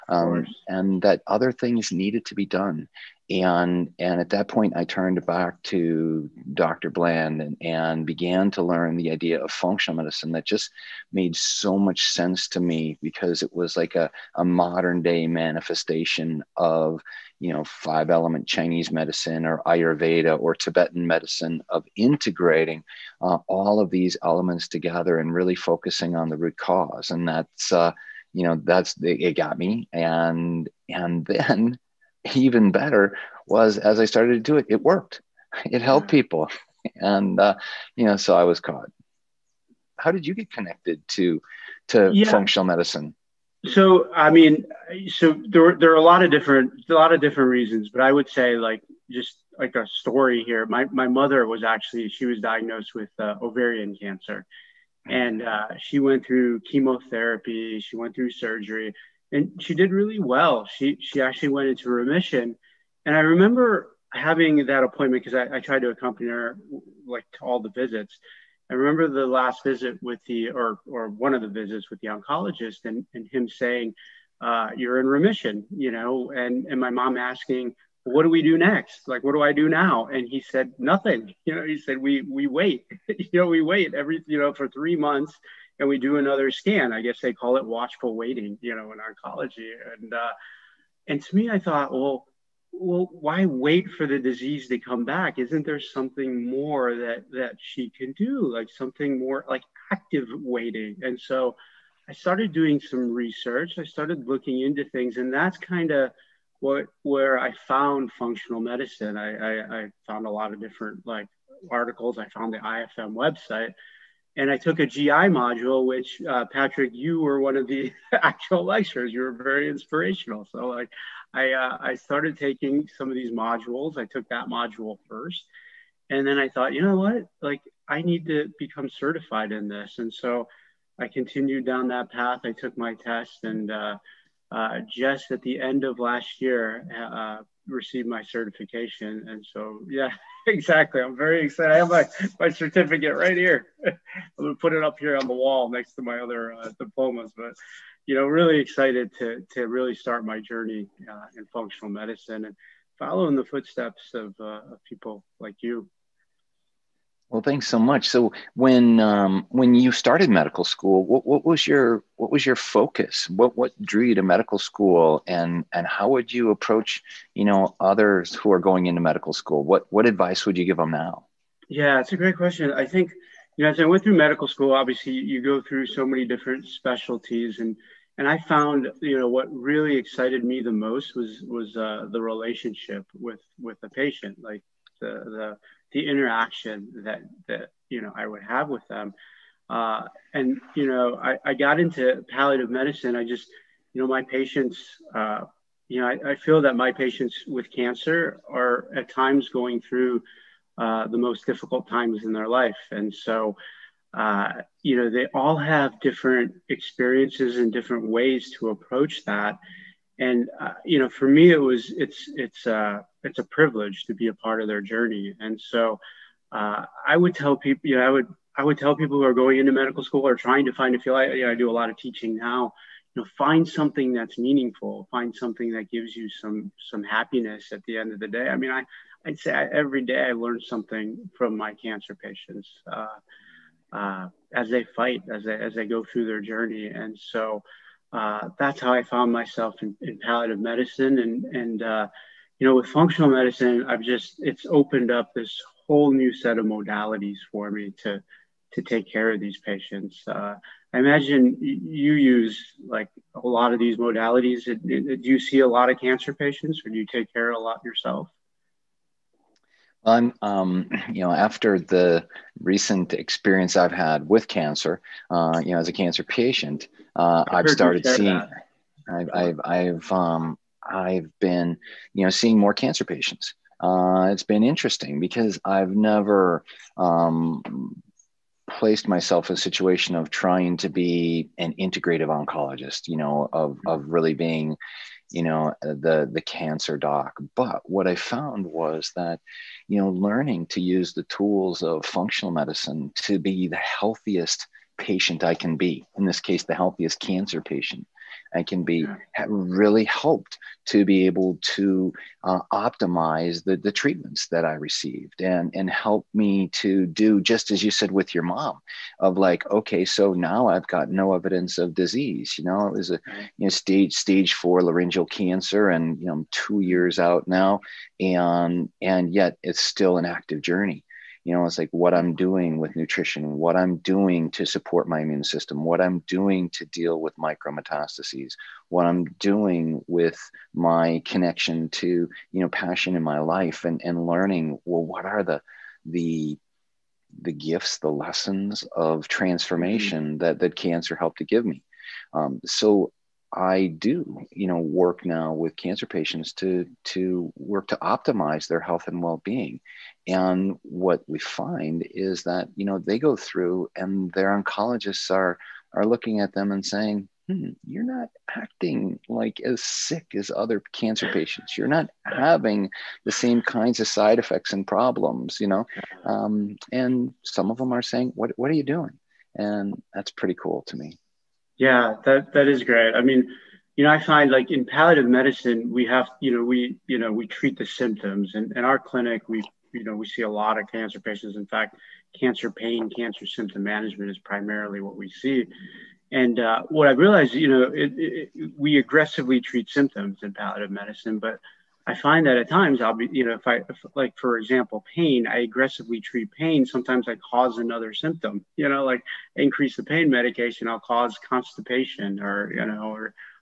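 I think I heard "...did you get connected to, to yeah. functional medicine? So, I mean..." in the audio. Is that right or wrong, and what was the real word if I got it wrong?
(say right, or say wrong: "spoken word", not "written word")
right.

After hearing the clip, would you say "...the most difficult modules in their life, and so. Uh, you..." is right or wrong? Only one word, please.
wrong.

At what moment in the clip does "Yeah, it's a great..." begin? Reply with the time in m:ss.
2:51.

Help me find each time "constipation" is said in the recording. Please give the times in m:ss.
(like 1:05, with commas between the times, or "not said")
6:41.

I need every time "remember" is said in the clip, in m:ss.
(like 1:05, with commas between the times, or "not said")
1:03, 1:08.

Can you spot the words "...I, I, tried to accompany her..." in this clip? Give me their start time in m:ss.
1:05.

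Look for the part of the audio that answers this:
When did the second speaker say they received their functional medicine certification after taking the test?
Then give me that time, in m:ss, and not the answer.
2:15.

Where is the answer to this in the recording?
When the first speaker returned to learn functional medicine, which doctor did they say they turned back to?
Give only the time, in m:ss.
0:06.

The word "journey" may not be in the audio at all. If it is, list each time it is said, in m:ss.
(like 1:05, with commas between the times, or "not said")
2:30, 3:34, 3:56, 5:20.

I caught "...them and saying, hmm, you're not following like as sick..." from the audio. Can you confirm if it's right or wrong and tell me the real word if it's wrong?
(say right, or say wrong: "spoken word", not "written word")
wrong: "acting", not "following".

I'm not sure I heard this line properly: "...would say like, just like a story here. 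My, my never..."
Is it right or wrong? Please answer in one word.
wrong.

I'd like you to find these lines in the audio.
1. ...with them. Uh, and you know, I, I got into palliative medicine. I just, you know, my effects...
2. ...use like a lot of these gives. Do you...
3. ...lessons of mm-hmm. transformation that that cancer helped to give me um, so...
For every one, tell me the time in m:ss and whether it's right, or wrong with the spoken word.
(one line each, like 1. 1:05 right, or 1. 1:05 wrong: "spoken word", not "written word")
1. 3:08 wrong: "patients", not "effects"
2. 4:12 wrong: "modalities", not "gives"
3. 5:38 right.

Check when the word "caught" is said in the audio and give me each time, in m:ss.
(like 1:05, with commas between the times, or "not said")
0:38.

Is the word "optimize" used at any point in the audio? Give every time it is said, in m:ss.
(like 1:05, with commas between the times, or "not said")
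5:02, 5:47.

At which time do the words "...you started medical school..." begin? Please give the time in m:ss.
2:39.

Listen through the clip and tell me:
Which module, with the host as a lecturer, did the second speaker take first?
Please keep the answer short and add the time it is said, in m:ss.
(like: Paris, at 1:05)
GI module, at 1:54.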